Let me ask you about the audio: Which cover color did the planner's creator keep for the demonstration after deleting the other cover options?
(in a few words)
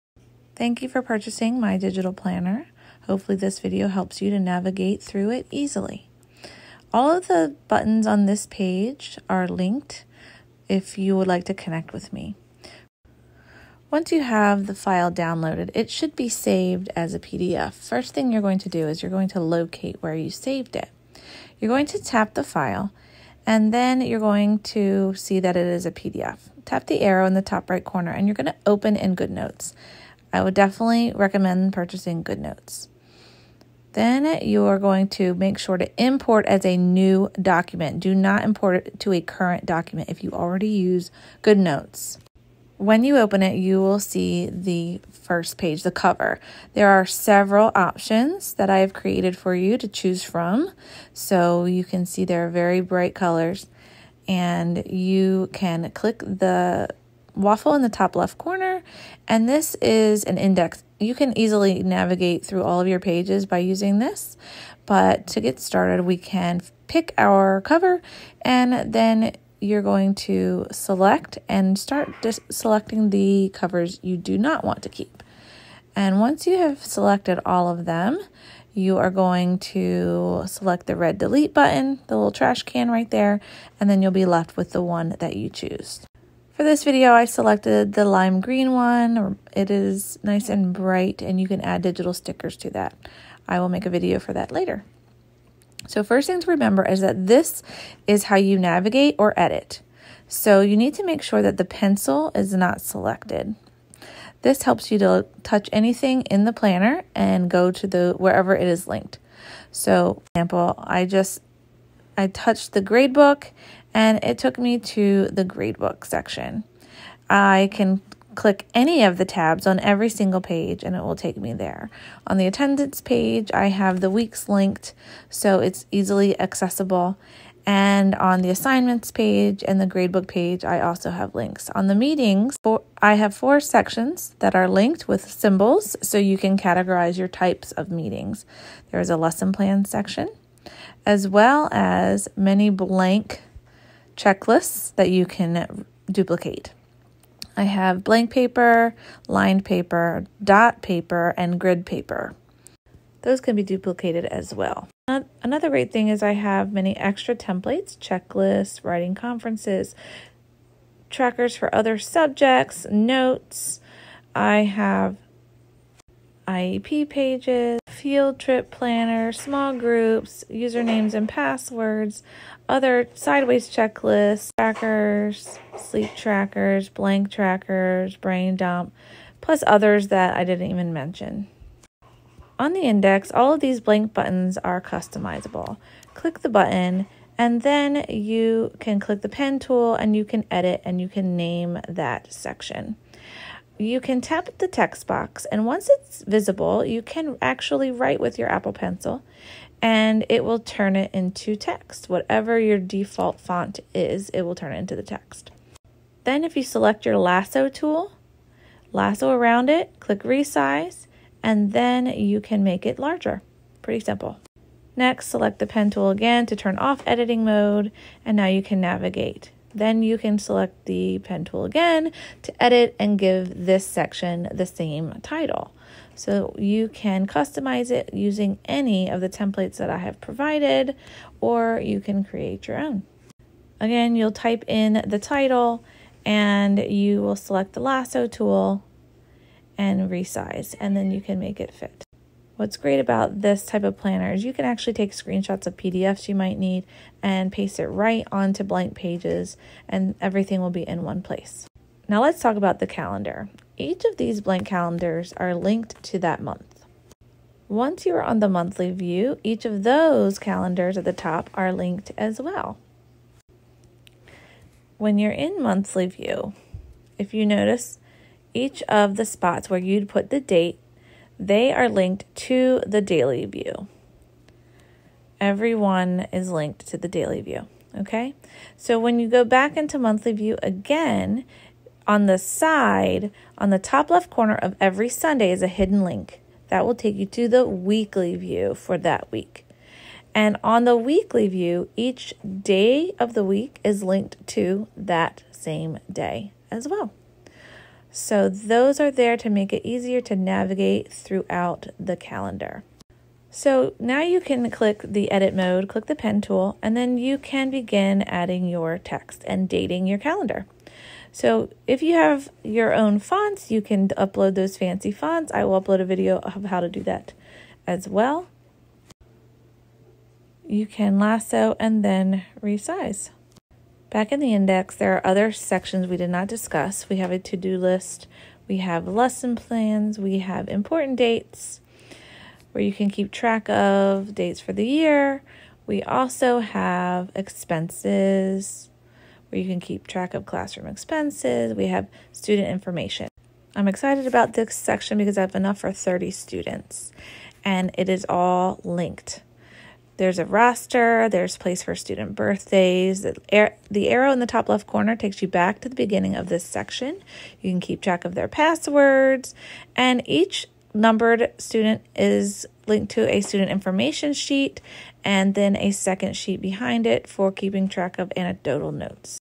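lime green.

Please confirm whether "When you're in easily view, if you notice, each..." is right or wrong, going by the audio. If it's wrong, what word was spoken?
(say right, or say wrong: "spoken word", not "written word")
wrong: "monthly", not "easily".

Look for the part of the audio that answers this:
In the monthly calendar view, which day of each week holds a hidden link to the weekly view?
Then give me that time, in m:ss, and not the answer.
4:45.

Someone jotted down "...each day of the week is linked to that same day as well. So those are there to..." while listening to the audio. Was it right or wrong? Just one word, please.
right.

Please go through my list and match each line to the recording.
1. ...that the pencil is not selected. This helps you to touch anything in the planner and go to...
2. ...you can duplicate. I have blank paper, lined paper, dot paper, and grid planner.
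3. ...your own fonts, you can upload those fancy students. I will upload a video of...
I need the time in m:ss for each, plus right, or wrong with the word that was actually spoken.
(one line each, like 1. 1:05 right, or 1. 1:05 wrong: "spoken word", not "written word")
1. 1:41 right
2. 2:25 wrong: "paper", not "planner"
3. 5:12 wrong: "fonts", not "students".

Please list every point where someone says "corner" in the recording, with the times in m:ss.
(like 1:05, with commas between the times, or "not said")
0:27, 0:58, 4:44, 5:54.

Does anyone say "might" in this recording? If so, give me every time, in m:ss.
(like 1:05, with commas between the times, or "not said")
4:06.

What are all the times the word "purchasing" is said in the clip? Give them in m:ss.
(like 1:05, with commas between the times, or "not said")
0:01, 0:31.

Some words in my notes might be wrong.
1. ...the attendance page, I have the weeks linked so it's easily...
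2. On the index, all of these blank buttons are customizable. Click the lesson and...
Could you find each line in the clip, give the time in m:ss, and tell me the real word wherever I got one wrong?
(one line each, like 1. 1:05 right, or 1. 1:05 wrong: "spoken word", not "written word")
1. 2:02 right
2. 3:02 wrong: "button", not "lesson".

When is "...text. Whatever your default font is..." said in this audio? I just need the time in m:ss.
3:21.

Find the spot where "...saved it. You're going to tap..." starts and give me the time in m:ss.
0:20.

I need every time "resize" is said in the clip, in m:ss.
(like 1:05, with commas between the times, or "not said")
3:30, 4:00, 5:22.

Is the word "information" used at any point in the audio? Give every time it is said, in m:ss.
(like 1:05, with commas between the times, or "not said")
5:42, 6:03.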